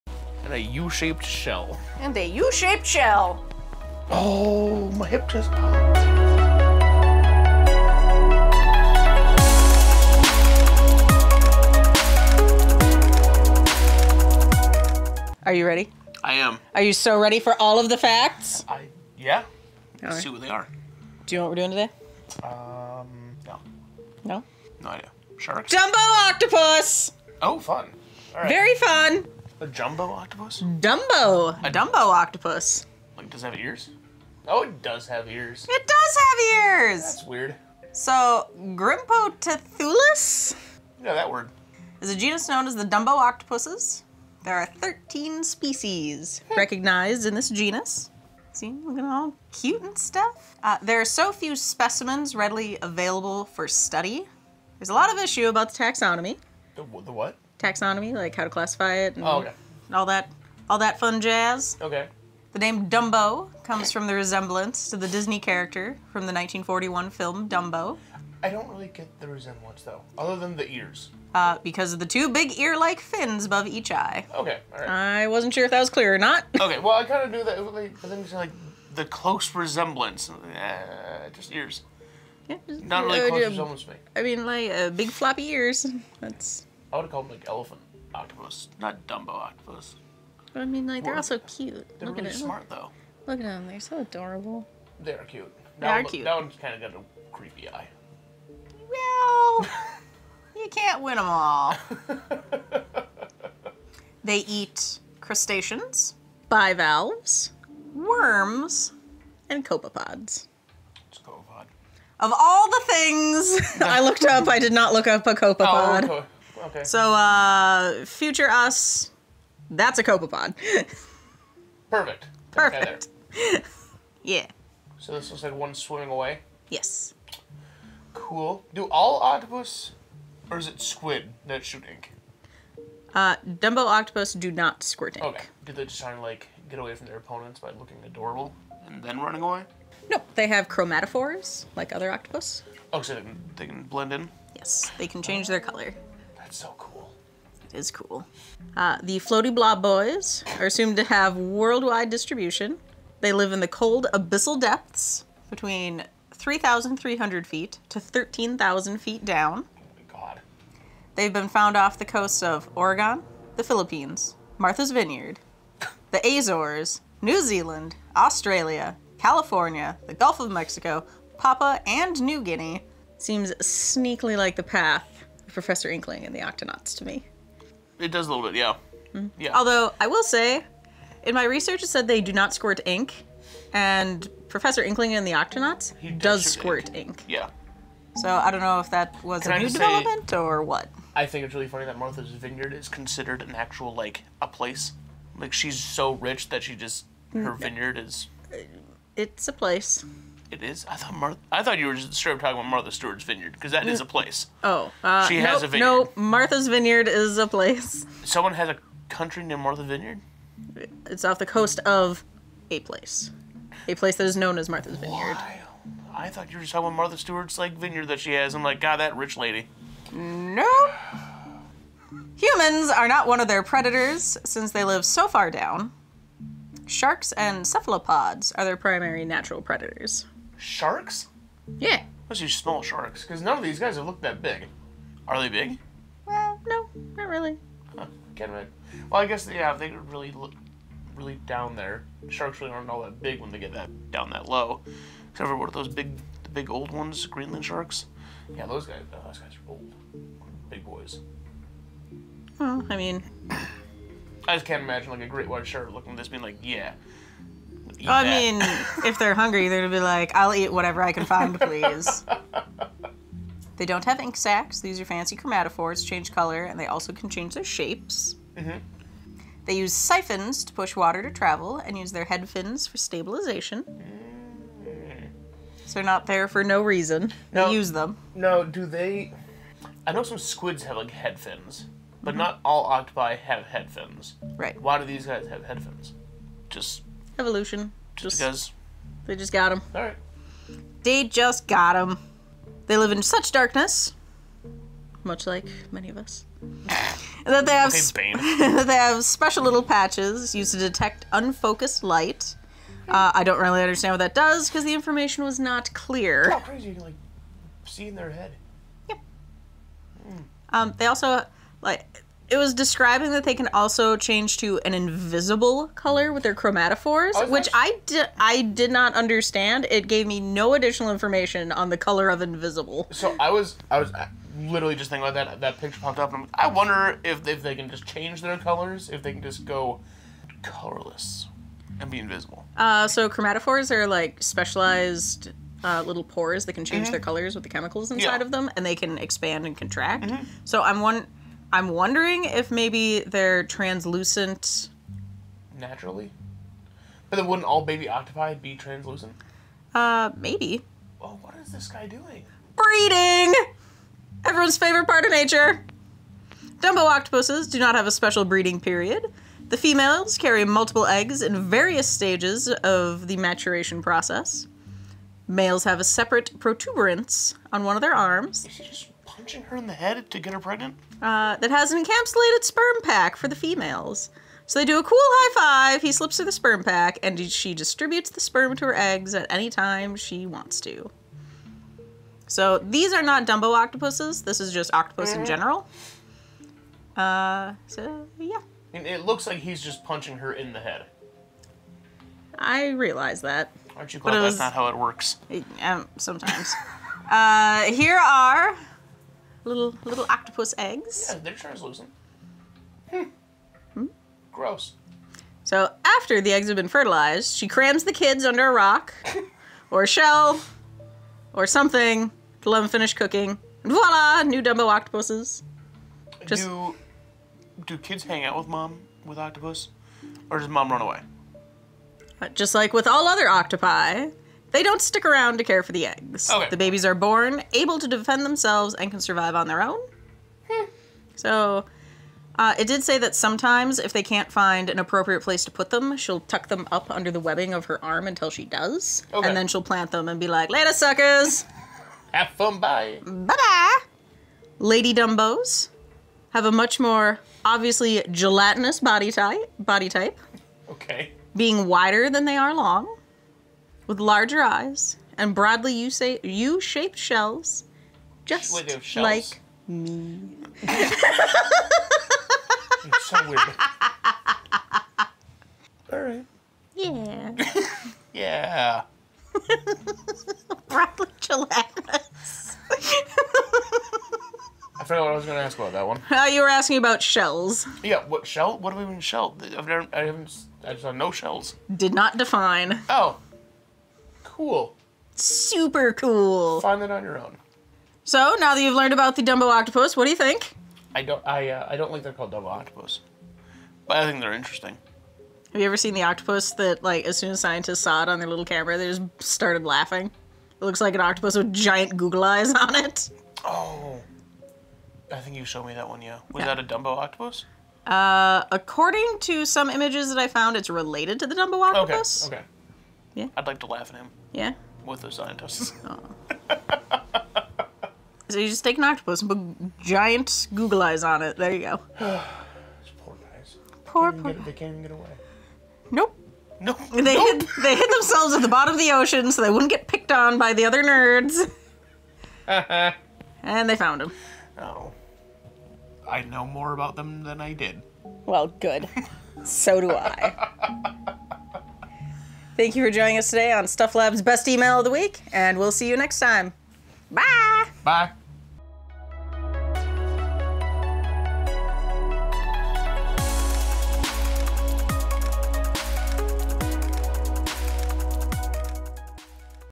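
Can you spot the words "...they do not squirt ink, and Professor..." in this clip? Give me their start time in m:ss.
3:02.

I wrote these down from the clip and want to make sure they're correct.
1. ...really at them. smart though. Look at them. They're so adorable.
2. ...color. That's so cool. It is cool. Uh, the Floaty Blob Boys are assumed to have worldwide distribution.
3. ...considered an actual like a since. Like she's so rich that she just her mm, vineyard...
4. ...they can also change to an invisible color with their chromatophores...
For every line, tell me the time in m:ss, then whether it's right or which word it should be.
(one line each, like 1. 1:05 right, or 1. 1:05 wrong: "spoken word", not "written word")
1. 1:32 right
2. 2:25 right
3. 3:12 wrong: "place", not "since"
4. 5:13 right.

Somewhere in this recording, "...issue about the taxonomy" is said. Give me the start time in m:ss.
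0:55.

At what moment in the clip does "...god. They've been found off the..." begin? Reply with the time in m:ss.
2:40.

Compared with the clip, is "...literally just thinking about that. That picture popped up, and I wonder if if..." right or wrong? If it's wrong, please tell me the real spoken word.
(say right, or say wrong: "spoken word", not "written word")
right.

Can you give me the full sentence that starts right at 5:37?
their colors with the chemicals inside yeah.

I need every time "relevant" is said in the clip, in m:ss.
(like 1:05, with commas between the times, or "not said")
not said.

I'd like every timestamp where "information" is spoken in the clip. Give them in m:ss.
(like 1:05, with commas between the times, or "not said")
5:04, 5:21.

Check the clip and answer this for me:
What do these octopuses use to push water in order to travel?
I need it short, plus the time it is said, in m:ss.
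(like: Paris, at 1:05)
siphons, at 4:29.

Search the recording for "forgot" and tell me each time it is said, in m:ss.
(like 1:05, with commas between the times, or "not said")
7:55.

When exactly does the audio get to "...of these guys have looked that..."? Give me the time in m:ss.
3:53.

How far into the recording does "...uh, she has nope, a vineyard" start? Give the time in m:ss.
3:25.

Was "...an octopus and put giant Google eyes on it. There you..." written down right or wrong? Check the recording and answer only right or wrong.
right.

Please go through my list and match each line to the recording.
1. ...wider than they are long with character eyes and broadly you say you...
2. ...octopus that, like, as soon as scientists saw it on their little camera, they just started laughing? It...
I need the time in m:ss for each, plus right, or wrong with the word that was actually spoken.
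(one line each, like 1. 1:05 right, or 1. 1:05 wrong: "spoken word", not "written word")
1. 7:31 wrong: "larger", not "character"
2. 8:16 right.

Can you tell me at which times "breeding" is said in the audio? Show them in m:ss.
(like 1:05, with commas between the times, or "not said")
5:52, 5:58.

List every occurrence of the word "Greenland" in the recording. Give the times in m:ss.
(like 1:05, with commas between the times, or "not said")
4:07.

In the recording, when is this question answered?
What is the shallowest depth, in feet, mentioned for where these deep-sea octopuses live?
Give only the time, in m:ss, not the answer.
2:36.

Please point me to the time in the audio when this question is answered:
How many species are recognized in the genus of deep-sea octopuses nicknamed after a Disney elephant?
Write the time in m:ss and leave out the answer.
0:44.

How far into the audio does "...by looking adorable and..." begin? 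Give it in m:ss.
2:17.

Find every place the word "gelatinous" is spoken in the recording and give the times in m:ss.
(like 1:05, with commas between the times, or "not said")
7:28, 7:51.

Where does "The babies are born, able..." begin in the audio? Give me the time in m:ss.
7:06.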